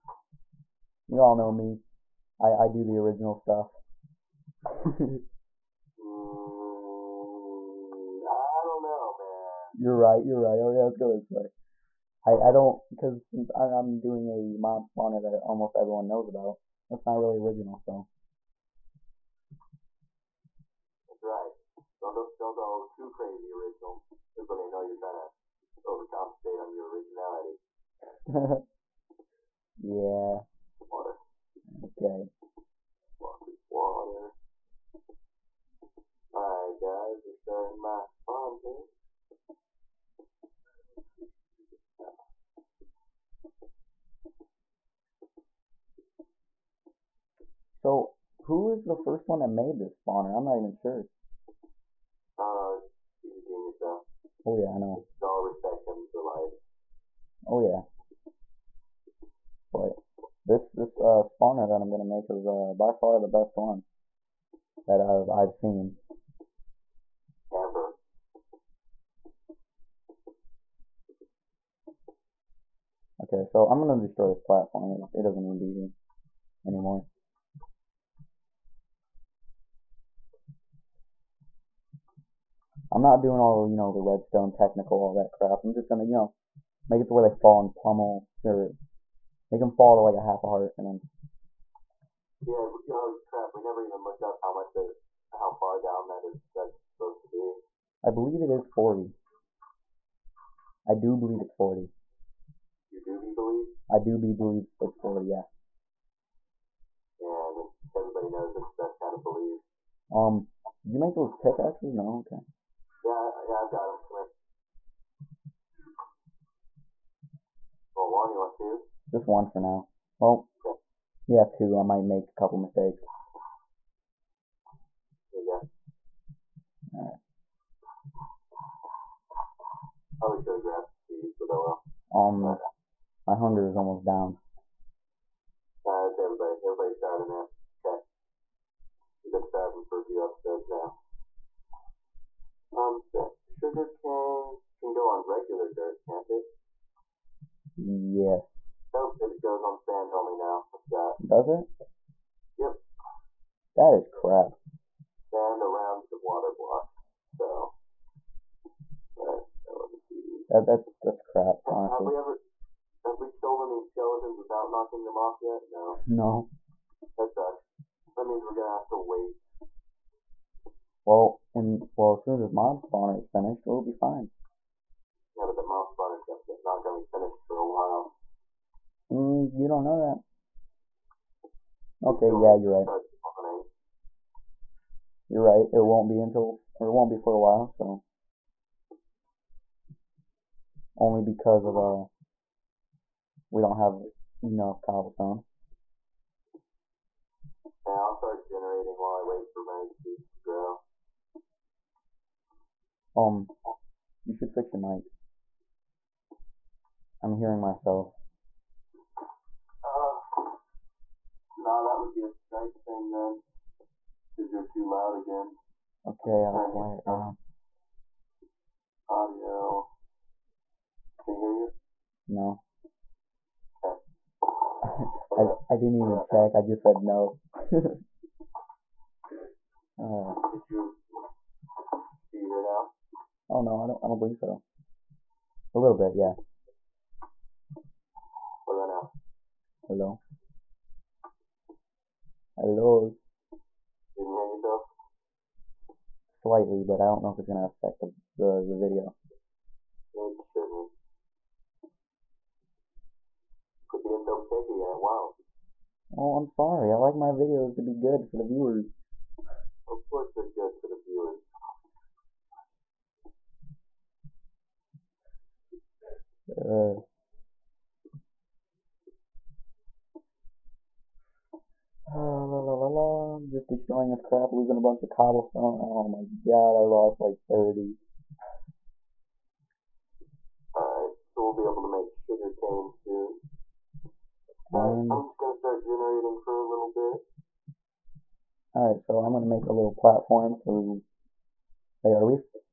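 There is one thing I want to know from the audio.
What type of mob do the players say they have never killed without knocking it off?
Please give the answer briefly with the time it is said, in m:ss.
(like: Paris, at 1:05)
Skeletons, at 2:43.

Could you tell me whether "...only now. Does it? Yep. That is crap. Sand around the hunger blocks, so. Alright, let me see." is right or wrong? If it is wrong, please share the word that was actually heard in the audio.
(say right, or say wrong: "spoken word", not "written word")
wrong: "water", not "hunger".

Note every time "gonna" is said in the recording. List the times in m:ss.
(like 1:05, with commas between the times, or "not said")
2:48, 2:56, 4:07.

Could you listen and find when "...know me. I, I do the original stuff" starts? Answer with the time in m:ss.
0:01.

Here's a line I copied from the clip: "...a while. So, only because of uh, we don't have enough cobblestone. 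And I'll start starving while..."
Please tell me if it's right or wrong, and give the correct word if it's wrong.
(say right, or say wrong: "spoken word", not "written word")
wrong: "generating", not "starving".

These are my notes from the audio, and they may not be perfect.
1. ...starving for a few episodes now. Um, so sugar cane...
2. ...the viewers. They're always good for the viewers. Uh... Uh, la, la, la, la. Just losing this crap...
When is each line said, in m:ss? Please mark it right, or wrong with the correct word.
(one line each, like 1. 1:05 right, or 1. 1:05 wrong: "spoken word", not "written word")
1. 2:19 right
2. 4:20 wrong: "destroying", not "losing".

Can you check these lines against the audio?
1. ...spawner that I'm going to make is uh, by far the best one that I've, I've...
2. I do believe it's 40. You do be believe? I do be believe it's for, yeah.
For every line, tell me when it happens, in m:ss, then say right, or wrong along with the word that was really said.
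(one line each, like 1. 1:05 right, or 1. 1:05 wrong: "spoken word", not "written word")
1. 1:01 right
2. 1:40 right.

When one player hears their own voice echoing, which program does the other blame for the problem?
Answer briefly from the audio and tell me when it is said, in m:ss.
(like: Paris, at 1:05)
Skype, at 3:32.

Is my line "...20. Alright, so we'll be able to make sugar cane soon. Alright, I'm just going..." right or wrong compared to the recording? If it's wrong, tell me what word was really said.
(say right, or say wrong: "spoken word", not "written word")
wrong: "30", not "20".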